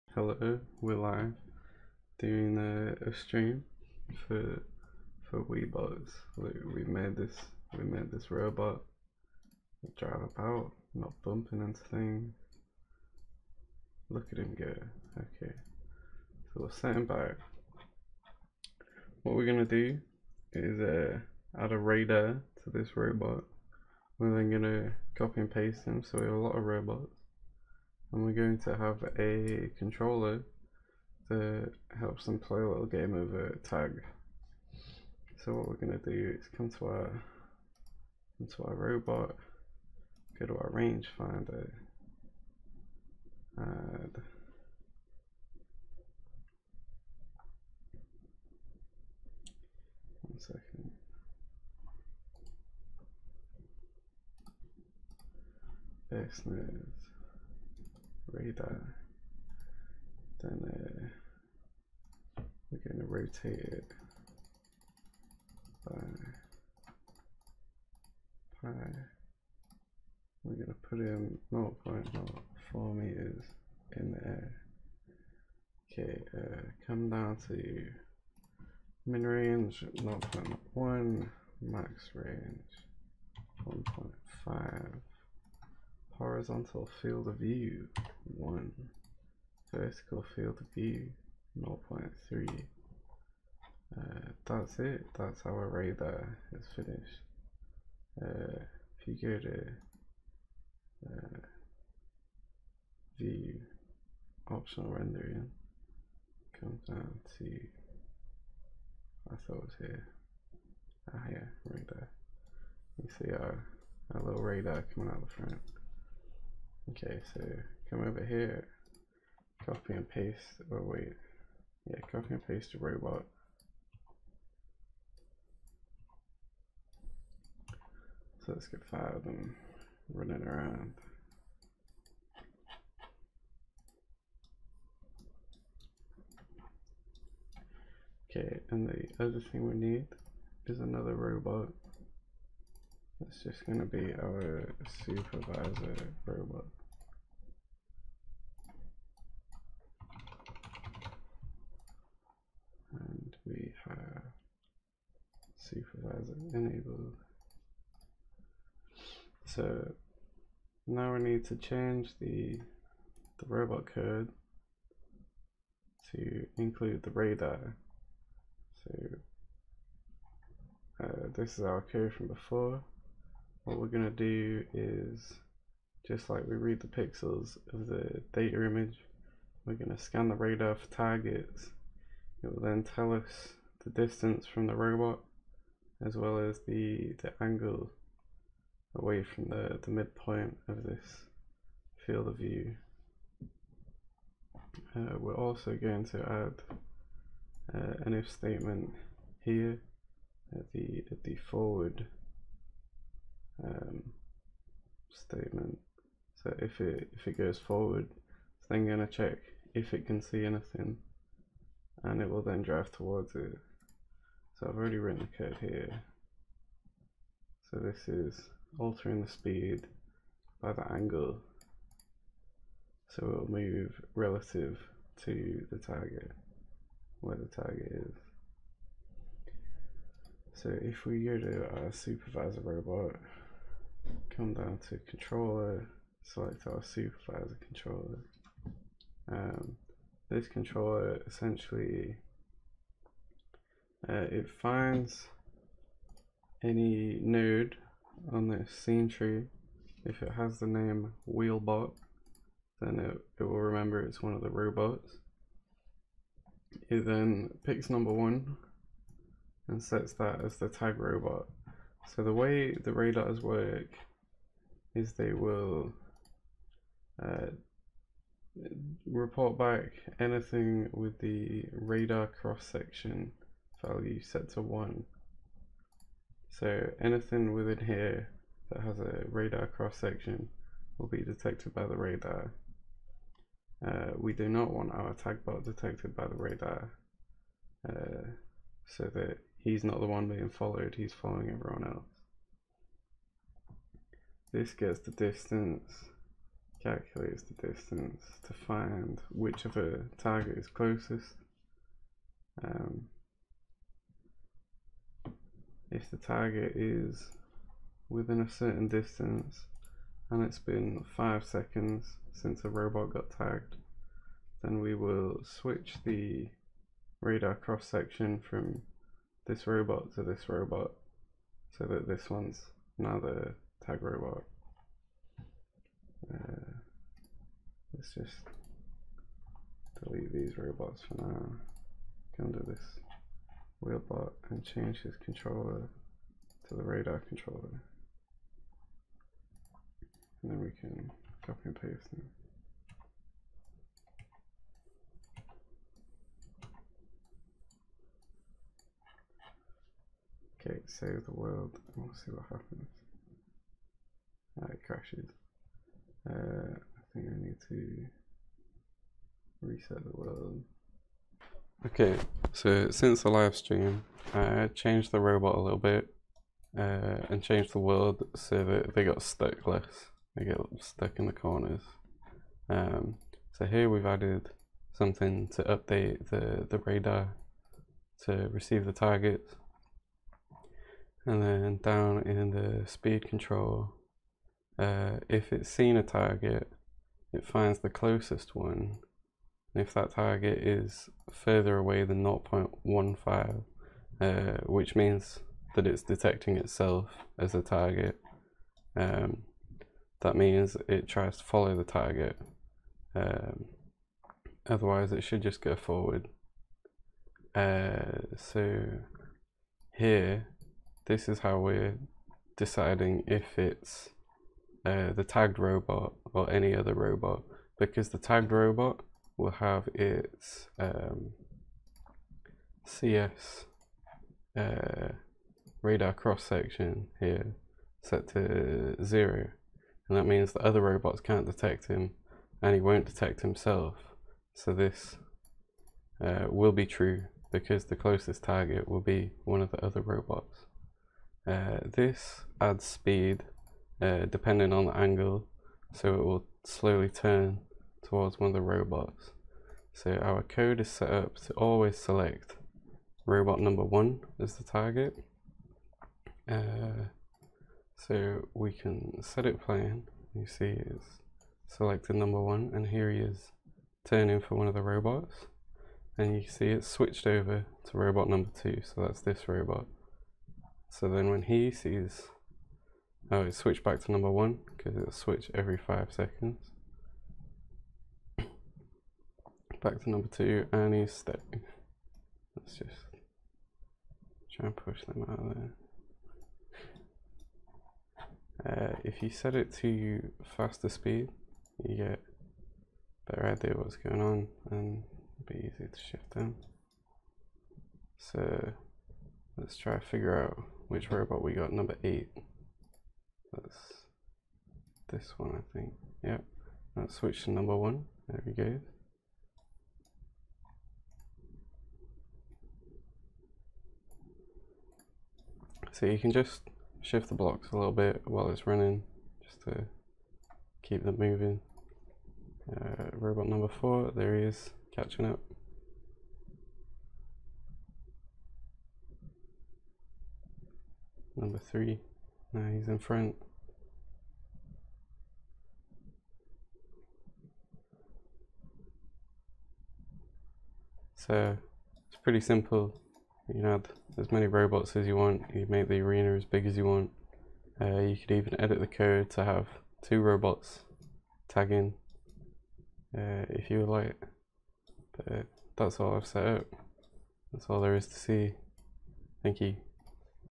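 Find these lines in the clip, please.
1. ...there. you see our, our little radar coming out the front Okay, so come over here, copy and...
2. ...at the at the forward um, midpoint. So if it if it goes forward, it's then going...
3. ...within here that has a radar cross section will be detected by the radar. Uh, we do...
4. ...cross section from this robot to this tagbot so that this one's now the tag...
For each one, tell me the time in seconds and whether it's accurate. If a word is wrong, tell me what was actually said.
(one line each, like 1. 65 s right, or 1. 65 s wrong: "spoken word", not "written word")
1. 111 s right
2. 200 s wrong: "statement", not "midpoint"
3. 277 s right
4. 317 s wrong: "robot", not "tagbot".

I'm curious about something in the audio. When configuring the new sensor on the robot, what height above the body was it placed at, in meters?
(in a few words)
0.04.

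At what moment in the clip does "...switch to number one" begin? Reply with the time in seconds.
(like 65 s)
507 s.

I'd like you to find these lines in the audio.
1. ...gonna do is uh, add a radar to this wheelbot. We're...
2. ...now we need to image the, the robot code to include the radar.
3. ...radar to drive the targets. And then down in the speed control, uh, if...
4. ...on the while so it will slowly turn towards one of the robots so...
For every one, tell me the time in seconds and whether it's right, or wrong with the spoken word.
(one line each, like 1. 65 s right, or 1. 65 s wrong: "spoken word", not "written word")
1. 19 s wrong: "robot", not "wheelbot"
2. 160 s wrong: "change", not "image"
3. 376 s wrong: "receive", not "drive"
4. 444 s wrong: "angle", not "while".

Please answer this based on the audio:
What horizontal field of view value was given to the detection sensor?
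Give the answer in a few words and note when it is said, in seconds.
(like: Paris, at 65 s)
1, at 86 s.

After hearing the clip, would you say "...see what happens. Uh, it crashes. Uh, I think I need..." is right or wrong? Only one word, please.
right.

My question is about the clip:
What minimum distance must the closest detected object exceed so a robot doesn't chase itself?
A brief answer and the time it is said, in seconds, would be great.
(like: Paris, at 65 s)
0.15, at 392 s.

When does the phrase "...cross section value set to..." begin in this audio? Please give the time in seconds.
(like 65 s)
272 s.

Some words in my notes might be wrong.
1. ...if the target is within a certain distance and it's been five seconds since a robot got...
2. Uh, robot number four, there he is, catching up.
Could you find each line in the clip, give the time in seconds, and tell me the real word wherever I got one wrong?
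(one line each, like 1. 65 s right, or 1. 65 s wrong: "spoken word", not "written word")
1. 305 s right
2. 522 s right.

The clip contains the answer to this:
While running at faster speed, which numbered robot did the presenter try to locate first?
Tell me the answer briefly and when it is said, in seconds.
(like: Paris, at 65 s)
8, at 501 s.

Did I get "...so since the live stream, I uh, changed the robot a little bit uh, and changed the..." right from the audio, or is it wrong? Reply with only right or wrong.
right.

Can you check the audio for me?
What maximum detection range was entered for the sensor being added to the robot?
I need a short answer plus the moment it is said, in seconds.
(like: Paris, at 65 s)
1.5, at 81 s.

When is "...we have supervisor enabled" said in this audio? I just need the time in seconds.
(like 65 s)
153 s.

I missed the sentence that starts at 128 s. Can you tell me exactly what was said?
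So let's get five of them running around.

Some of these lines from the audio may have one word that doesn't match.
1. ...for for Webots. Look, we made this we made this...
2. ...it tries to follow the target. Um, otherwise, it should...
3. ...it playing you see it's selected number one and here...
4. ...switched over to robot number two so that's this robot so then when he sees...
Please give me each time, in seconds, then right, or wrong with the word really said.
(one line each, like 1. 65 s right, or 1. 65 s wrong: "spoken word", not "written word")
1. 4 s right
2. 400 s right
3. 459 s right
4. 466 s right.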